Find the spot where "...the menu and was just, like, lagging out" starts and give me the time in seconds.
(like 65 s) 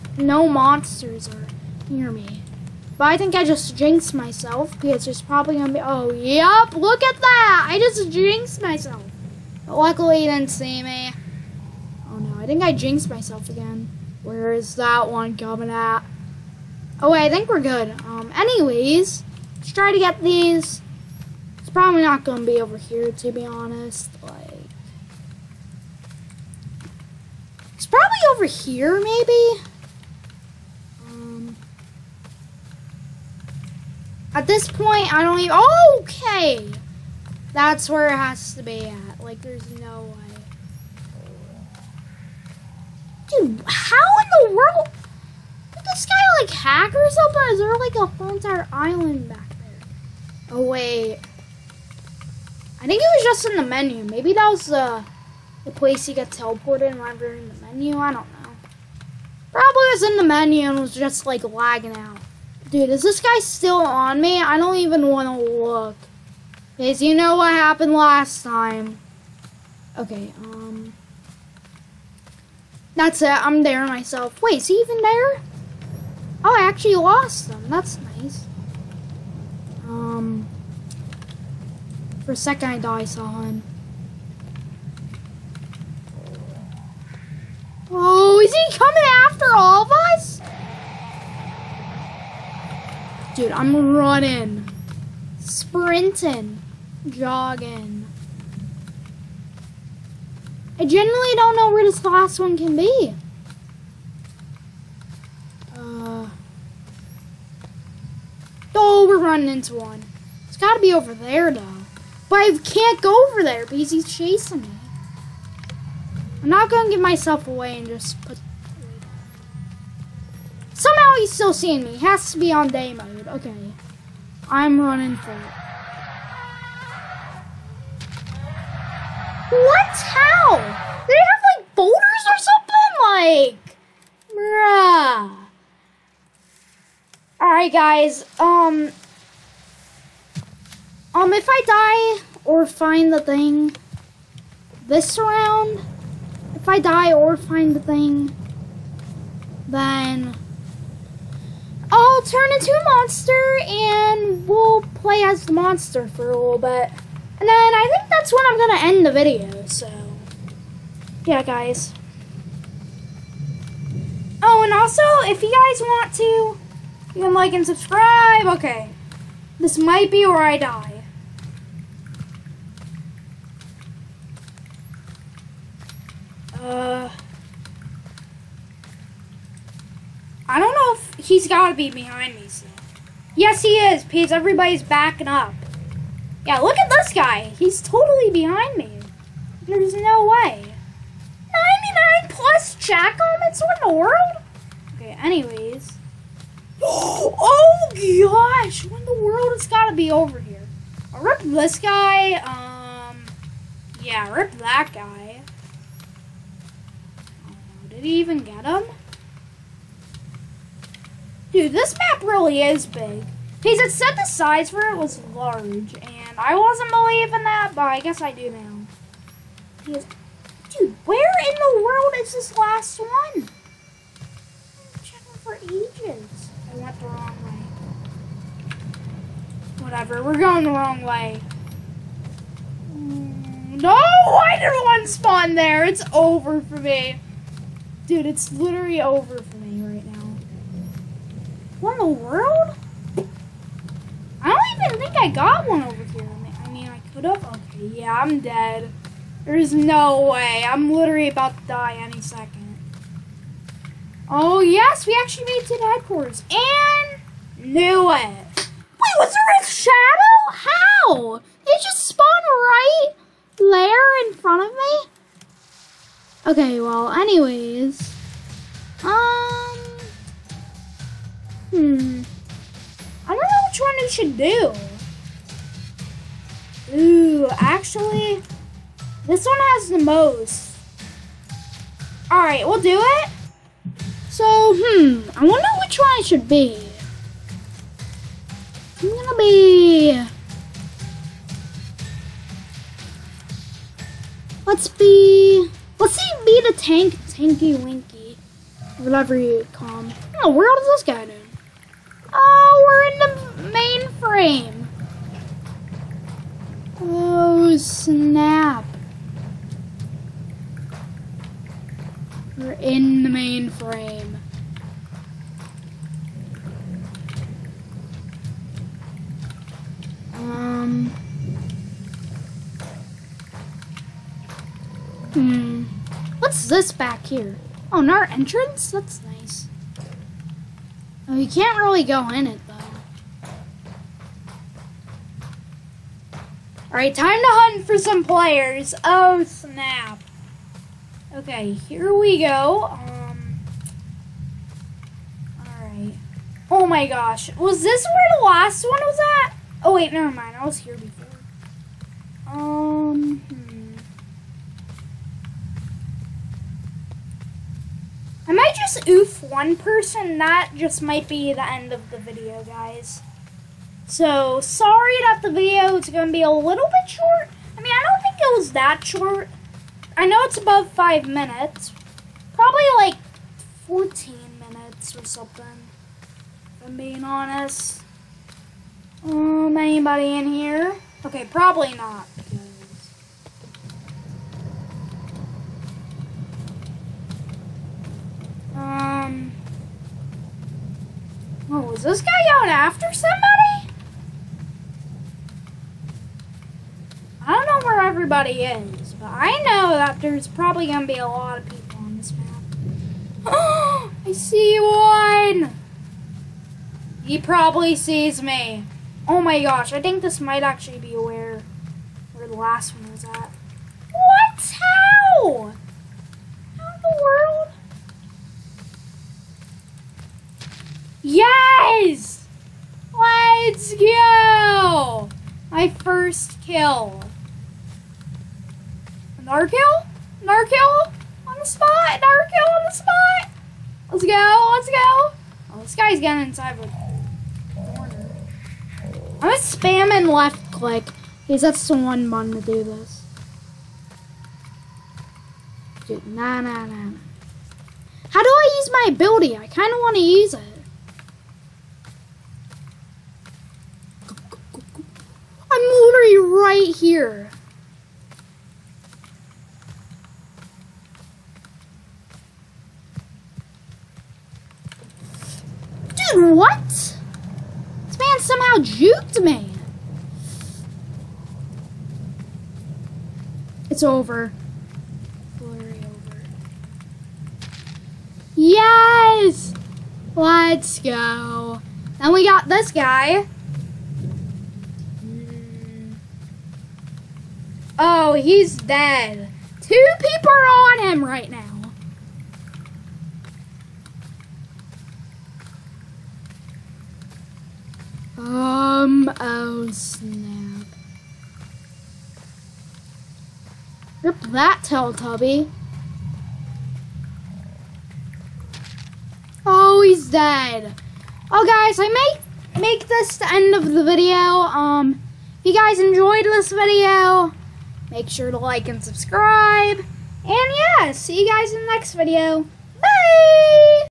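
60 s.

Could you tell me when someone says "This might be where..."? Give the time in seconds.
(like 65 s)
169 s.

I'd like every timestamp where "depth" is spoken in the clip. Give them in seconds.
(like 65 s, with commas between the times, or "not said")
not said.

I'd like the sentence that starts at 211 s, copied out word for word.
Dude, this map really is big.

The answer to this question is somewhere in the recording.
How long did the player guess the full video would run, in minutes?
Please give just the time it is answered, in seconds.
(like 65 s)
373 s.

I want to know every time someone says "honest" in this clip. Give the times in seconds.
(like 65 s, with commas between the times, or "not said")
23 s, 377 s.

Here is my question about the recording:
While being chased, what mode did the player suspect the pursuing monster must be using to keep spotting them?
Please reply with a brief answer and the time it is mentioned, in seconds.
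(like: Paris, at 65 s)
day mode, at 122 s.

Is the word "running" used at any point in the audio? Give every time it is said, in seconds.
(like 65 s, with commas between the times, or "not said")
93 s, 109 s, 124 s.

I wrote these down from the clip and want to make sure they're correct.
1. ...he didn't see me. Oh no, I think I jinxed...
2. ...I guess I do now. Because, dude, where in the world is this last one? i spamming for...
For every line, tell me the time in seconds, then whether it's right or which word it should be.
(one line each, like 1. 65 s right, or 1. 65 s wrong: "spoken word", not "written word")
1. 10 s right
2. 217 s wrong: "checking", not "spamming".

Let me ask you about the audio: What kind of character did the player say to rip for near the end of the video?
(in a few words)
Teletubby.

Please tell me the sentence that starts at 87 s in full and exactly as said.
Oh, is he coming after all of us?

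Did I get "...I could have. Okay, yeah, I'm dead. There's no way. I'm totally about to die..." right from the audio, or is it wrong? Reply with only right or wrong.
wrong.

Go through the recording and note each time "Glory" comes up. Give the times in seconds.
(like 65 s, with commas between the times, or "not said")
475 s.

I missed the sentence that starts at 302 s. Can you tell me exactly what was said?
Oh, we're in the main frame.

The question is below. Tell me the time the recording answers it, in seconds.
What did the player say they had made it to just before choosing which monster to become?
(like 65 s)
255 s.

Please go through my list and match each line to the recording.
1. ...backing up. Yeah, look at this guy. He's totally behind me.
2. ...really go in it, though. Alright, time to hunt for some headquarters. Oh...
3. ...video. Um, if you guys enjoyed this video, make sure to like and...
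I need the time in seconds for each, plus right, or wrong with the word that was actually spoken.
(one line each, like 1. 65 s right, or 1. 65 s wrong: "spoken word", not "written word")
1. 184 s right
2. 331 s wrong: "players", not "headquarters"
3. 514 s right.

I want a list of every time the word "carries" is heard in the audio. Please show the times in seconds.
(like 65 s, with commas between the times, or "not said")
not said.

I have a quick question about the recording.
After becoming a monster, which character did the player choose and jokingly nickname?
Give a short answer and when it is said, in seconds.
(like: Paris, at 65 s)
Tanky Winky, at 297 s.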